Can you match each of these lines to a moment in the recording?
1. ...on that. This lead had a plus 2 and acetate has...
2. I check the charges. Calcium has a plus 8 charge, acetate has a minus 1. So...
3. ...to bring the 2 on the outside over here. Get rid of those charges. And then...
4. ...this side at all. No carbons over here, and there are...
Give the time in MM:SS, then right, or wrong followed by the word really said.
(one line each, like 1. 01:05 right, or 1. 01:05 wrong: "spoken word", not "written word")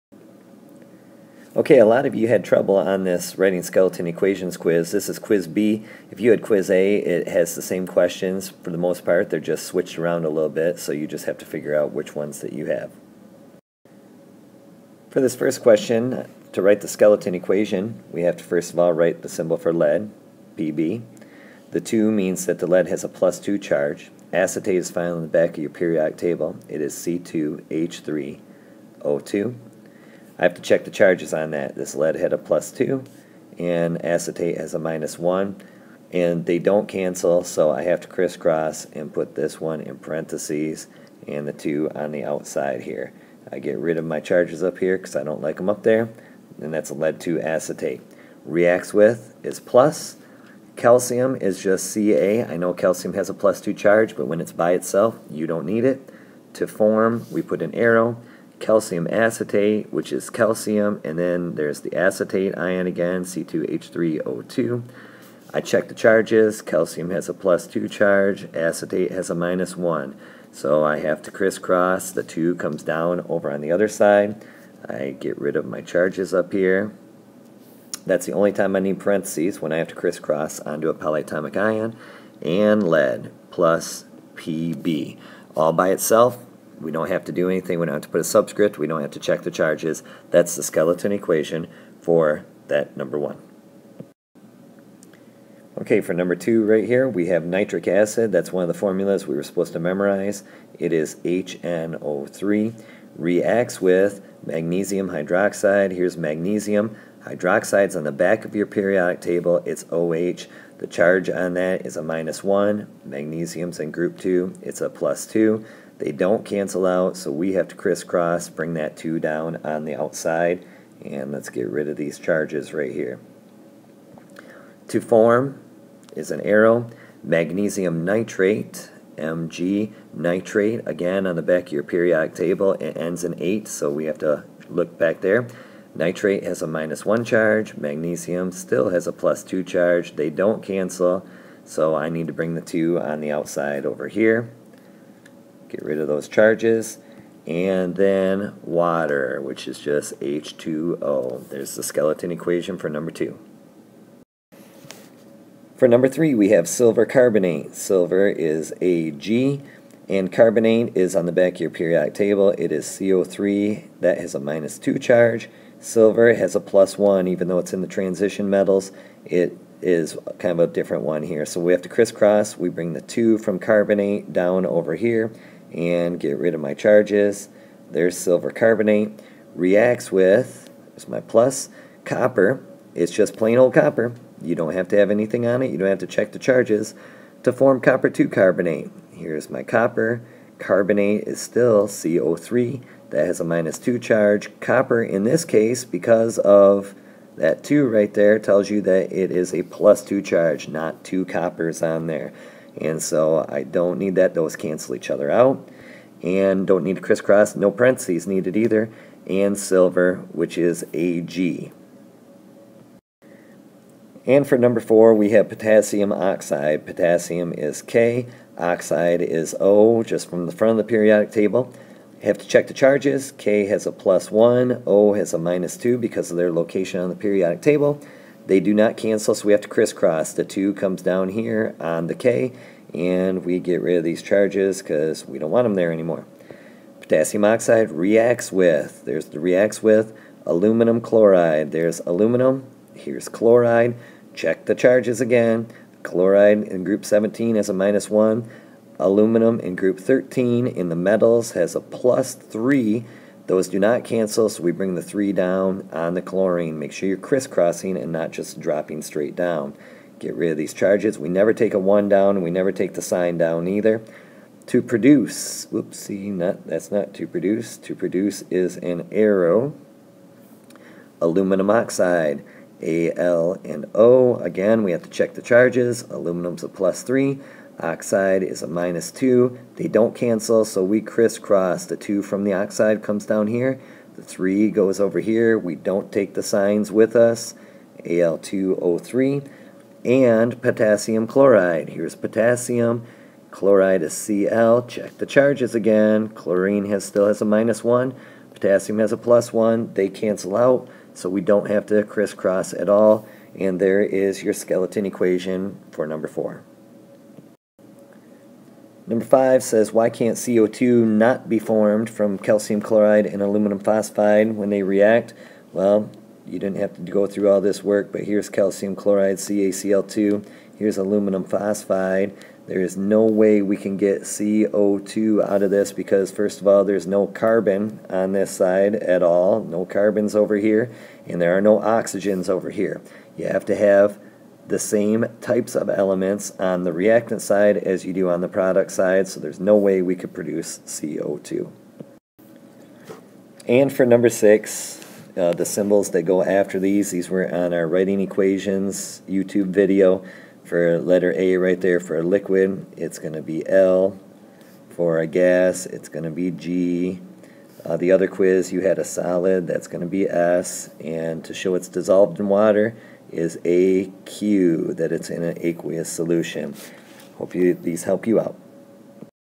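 1. 00:31 right
2. 01:05 wrong: "2", not "8"
3. 02:22 right
4. 05:28 right.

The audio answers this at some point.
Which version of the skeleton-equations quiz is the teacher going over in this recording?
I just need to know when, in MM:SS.
00:05.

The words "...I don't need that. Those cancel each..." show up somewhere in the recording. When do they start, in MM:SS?
03:23.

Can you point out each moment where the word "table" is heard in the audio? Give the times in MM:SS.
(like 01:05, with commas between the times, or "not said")
00:26, 01:49, 02:12, 02:42, 03:41, 03:47.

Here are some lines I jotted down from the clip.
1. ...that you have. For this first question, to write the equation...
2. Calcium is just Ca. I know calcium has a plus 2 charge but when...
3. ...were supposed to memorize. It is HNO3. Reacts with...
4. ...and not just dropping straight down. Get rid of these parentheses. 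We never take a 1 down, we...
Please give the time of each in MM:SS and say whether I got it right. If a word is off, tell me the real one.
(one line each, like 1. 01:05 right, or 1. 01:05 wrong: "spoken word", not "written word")
1. 00:12 wrong: "skeleton", not "equation"
2. 00:50 right
3. 01:39 right
4. 04:17 wrong: "charges", not "parentheses".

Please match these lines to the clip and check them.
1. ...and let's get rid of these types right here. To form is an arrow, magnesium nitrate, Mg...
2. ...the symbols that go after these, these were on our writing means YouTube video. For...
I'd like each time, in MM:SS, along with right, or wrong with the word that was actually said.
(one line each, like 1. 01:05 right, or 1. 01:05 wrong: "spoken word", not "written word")
1. 02:01 wrong: "charges", not "types"
2. 05:45 wrong: "equations", not "means".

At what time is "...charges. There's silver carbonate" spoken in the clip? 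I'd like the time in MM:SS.
02:56.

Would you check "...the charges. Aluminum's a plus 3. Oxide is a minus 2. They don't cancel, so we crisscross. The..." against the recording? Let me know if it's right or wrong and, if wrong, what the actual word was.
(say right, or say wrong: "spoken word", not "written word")
right.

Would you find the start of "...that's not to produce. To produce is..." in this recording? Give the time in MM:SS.
04:26.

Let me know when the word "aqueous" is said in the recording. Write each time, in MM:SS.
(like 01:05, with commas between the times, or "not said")
06:05.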